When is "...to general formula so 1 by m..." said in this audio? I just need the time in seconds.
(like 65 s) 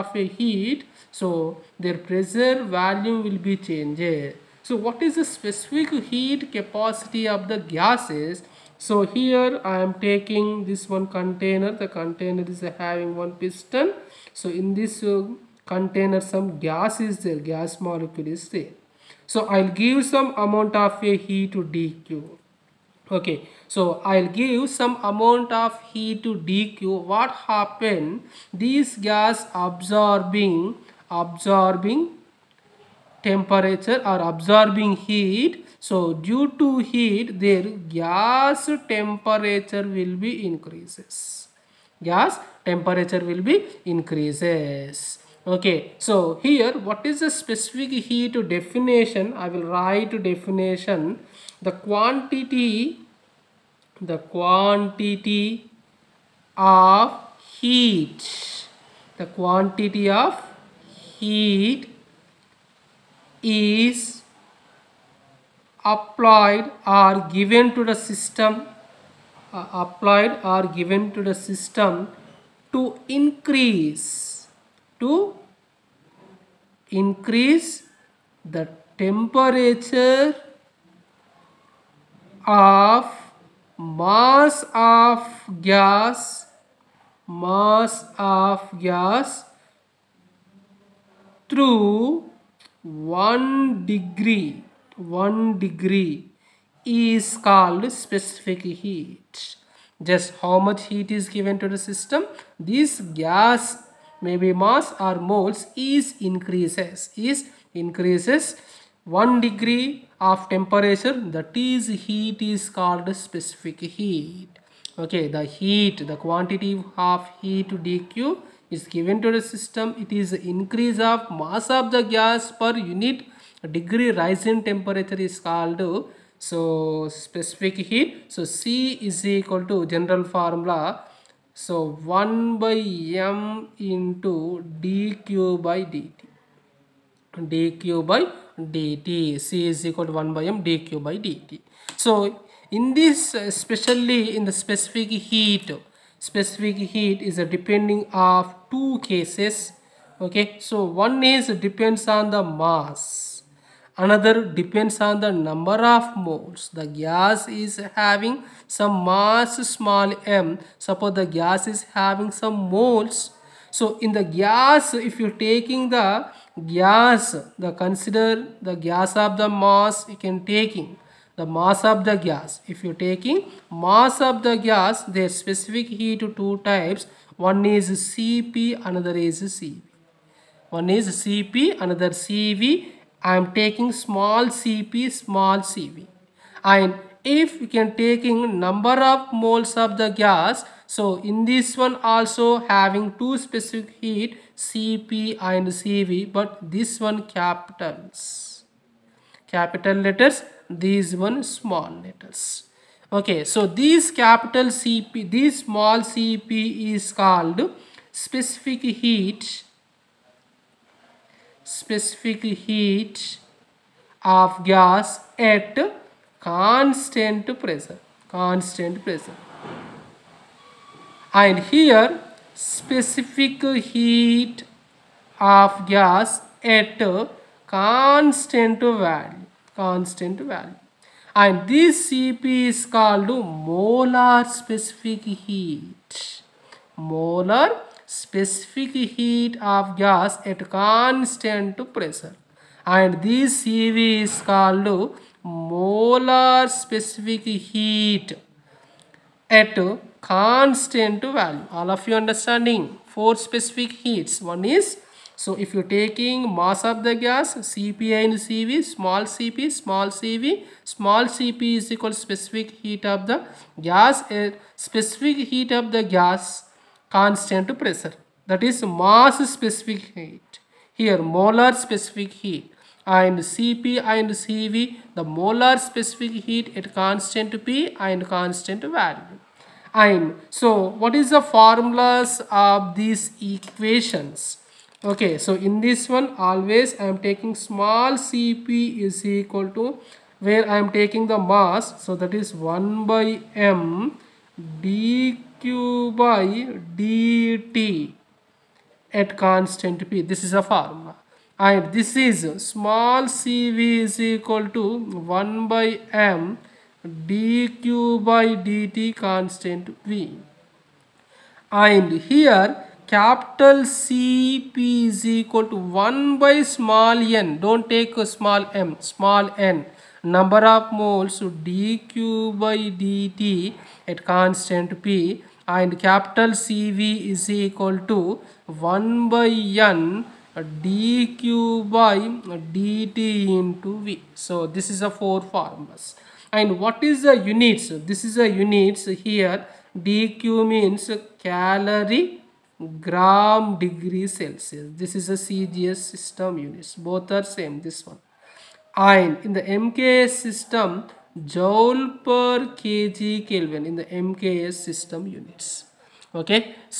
129 s.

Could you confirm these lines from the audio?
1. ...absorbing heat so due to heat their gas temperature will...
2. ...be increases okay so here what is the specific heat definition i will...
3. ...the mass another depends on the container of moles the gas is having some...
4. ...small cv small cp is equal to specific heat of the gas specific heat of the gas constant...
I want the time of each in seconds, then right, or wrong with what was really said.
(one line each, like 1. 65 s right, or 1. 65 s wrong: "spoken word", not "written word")
1. 34 s right
2. 43 s right
3. 152 s wrong: "number", not "container"
4. 259 s right.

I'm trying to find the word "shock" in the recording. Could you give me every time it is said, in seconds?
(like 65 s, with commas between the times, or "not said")
not said.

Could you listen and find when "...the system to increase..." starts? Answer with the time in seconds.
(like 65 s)
71 s.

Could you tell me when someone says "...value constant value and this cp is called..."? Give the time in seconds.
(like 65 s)
228 s.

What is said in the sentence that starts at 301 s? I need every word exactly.
And this is small cv is equal to 1 by m dq by dt constant V.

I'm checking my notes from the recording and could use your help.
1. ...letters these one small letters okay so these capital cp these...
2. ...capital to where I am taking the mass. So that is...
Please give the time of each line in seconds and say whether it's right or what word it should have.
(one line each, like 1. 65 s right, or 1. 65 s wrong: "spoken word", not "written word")
1. 200 s right
2. 289 s wrong: "equal", not "capital".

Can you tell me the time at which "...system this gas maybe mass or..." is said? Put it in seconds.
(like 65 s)
101 s.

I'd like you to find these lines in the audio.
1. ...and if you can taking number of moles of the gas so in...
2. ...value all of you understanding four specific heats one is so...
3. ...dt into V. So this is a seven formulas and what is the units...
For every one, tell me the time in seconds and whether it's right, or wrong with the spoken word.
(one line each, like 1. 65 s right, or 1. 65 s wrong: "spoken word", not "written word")
1. 186 s right
2. 251 s right
3. 332 s wrong: "four", not "seven".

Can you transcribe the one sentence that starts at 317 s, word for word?
Don't take a small m, small n.